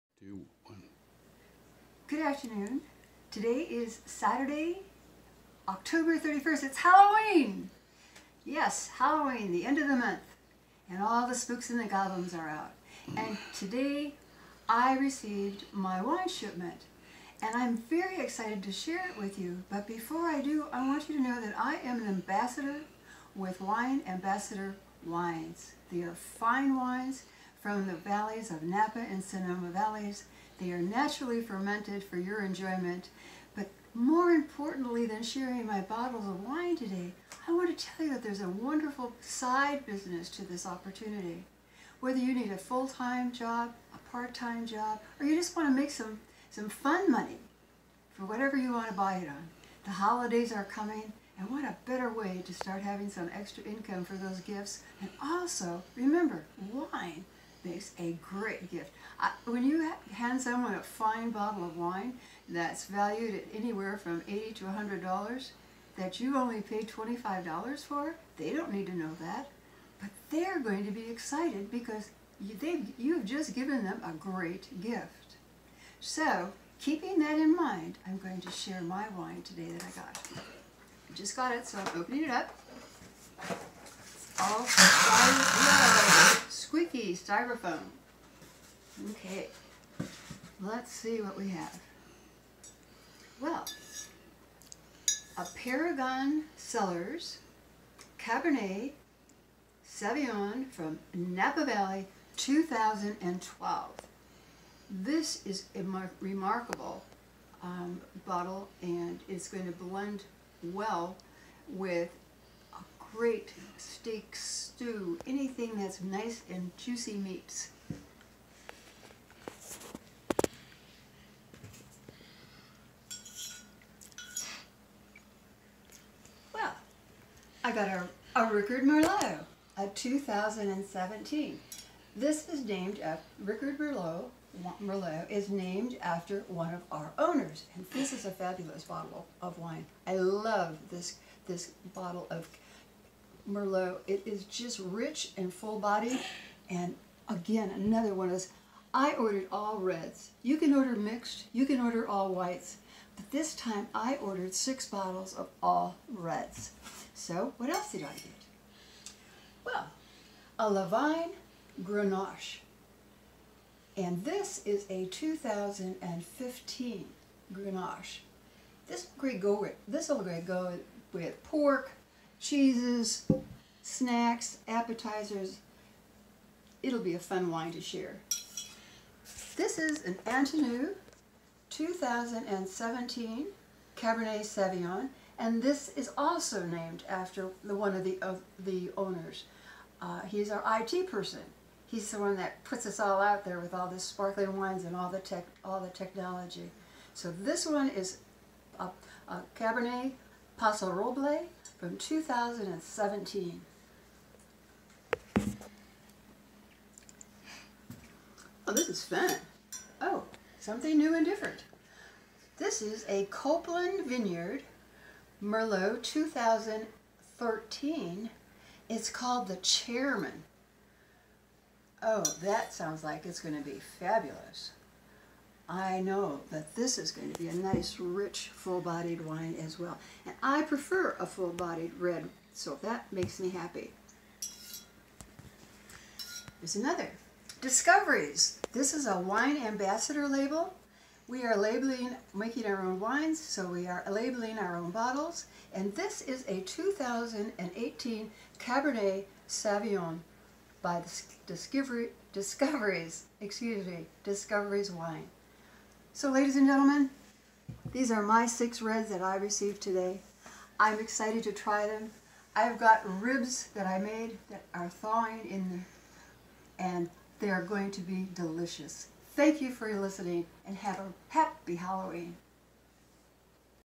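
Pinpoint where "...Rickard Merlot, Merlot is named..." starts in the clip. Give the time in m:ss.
2:13.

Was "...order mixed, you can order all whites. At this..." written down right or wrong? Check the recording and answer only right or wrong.
right.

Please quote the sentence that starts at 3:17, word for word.
So this one is a, a Cabernet Paso Roble from 2017.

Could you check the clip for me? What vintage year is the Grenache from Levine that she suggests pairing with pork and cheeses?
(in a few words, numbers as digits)
2015.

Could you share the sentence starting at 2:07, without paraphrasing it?
I got a, a Rickard Merlot, a 2017.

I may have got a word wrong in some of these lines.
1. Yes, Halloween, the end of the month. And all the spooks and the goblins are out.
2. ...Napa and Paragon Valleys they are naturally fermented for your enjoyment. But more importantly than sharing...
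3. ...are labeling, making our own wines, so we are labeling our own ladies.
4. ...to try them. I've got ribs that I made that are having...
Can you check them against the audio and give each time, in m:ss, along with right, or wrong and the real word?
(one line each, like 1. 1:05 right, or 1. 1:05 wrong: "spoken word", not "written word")
1. 0:08 right
2. 0:28 wrong: "Sonoma", not "Paragon"
3. 4:01 wrong: "bottles", not "ladies"
4. 4:21 wrong: "thawing", not "having".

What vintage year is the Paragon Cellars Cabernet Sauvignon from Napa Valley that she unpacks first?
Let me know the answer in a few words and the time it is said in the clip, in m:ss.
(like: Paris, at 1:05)
2012, at 1:42.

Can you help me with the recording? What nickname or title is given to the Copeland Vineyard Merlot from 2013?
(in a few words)
The Chairman.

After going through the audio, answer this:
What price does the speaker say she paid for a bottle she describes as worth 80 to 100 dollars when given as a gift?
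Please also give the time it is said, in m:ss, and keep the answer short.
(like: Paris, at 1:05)
$25, at 1:06.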